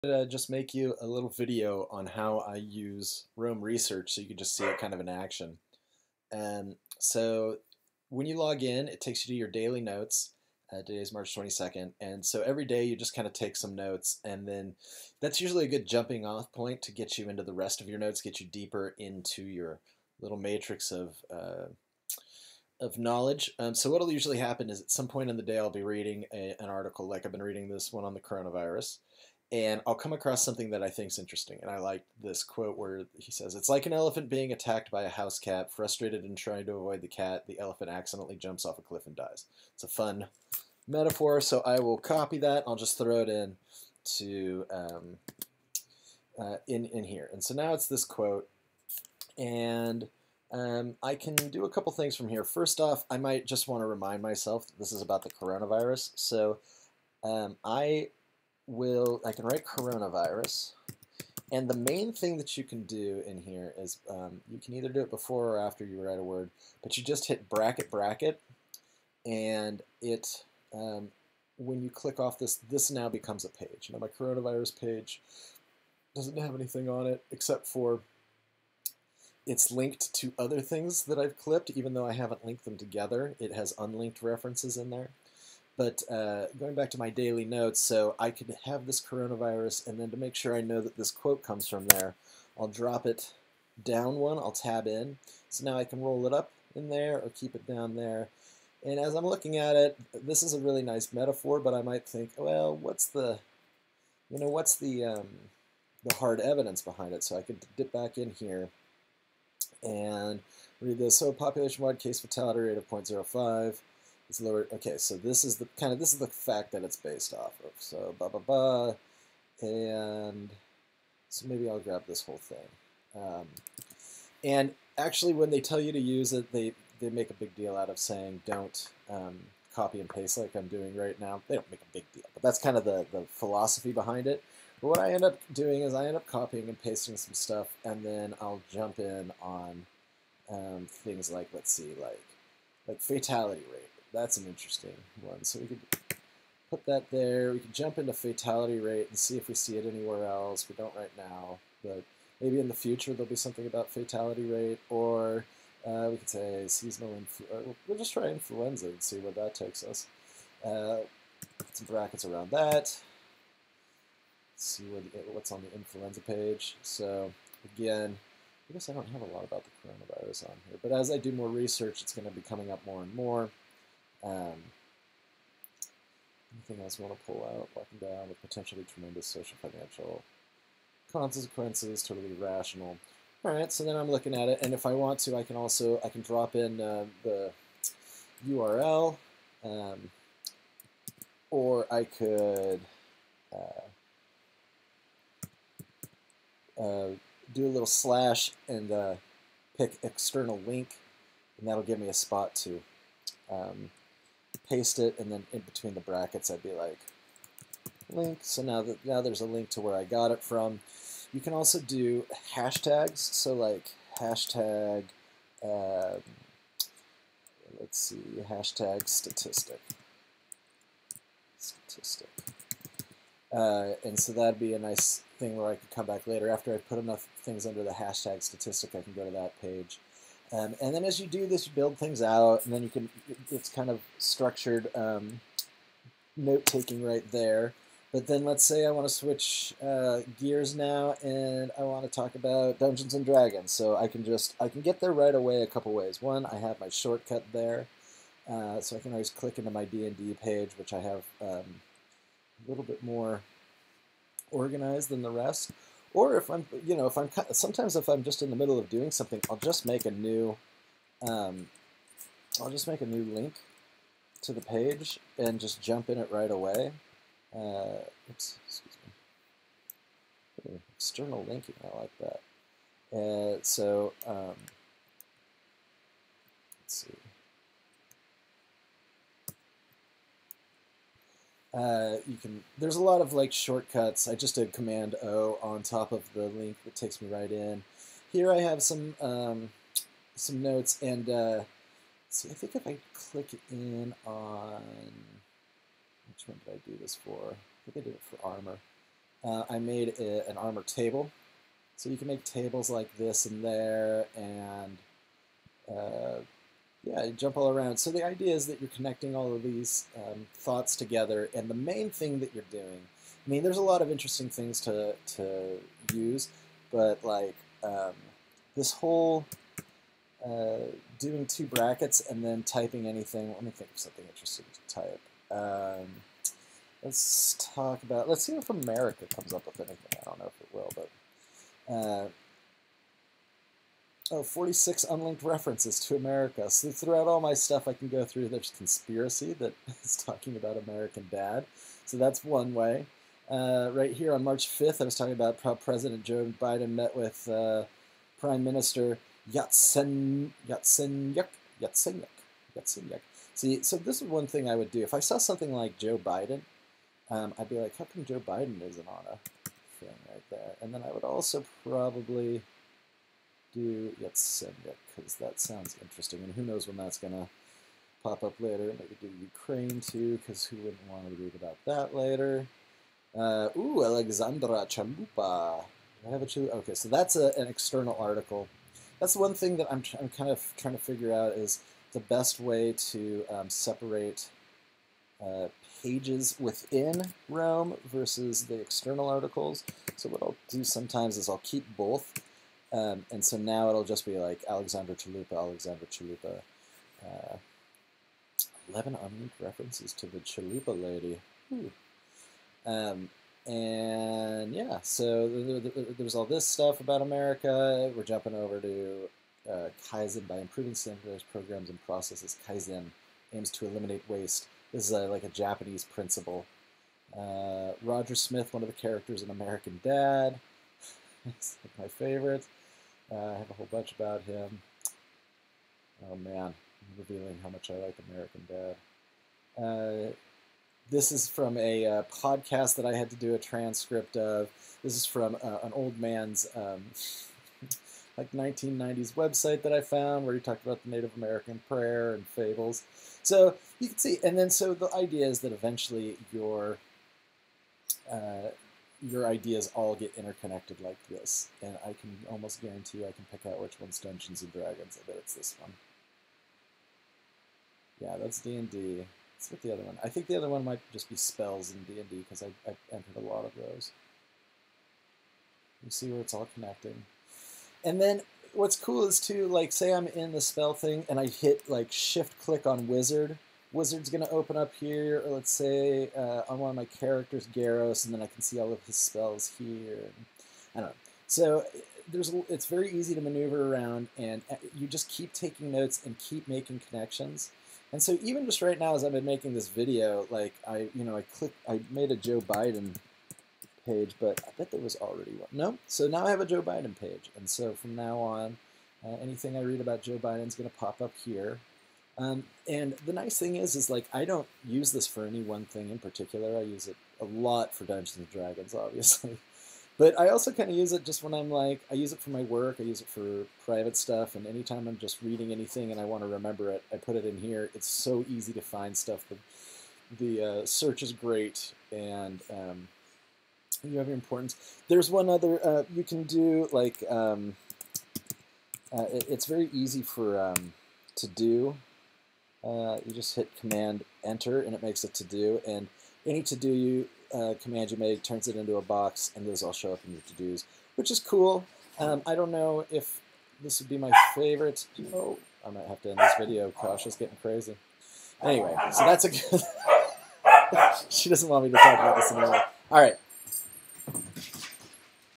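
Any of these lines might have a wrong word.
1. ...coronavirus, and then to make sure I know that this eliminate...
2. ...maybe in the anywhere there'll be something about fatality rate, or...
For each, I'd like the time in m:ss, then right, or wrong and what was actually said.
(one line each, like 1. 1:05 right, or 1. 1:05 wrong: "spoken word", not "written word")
1. 1:29 wrong: "quote", not "eliminate"
2. 2:32 wrong: "future", not "anywhere".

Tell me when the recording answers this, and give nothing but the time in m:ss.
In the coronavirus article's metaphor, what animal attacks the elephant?
0:35.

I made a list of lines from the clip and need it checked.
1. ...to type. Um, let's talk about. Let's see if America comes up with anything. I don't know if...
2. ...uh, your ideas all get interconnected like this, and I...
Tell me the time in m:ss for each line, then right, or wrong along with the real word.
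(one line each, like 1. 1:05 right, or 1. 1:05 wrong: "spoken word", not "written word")
1. 5:24 right
2. 7:28 right.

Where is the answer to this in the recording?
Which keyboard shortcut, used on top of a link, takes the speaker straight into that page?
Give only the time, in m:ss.
4:44.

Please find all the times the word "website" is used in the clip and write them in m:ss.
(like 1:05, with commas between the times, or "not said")
7:19.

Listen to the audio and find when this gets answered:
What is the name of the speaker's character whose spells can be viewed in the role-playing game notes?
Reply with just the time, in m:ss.
7:57.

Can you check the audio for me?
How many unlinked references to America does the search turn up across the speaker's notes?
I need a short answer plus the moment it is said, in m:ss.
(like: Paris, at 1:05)
46, at 5:34.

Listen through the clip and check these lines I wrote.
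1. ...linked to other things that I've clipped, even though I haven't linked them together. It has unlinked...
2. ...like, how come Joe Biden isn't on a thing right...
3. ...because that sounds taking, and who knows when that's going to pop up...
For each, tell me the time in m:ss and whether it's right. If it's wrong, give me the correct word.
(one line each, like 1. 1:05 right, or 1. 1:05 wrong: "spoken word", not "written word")
1. 1:19 right
2. 5:57 right
3. 6:05 wrong: "interesting", not "taking".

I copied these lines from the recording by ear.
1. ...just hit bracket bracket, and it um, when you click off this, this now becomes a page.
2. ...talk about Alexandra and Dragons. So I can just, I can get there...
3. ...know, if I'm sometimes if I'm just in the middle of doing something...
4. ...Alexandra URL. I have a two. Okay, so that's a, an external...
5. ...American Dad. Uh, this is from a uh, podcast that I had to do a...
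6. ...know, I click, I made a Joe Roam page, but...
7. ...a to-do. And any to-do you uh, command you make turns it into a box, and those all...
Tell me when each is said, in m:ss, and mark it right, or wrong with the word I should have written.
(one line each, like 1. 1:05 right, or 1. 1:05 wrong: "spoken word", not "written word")
1. 1:07 right
2. 4:02 wrong: "Dungeons", not "Alexandra"
3. 4:16 right
4. 6:14 wrong: "Chalupa", not "URL"
5. 7:08 right
6. 8:11 wrong: "Biden", not "Roam"
7. 8:55 right.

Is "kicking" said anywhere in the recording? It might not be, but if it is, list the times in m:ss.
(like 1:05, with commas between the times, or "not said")
not said.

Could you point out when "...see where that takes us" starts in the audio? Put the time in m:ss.
2:39.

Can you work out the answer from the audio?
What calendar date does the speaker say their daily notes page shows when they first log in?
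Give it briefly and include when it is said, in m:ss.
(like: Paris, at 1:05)
March 22nd, at 0:11.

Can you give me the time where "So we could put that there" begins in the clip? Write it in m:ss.
2:25.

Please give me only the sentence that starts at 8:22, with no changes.
Um, and the nice thing is, is like I don't use this for any one thing in particular.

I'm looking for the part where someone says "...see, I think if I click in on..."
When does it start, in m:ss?
4:52.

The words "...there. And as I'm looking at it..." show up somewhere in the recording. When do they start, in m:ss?
1:37.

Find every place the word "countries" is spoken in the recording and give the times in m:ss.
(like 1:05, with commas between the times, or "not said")
not said.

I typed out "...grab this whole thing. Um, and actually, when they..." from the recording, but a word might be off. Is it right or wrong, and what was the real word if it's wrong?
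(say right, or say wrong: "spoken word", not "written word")
right.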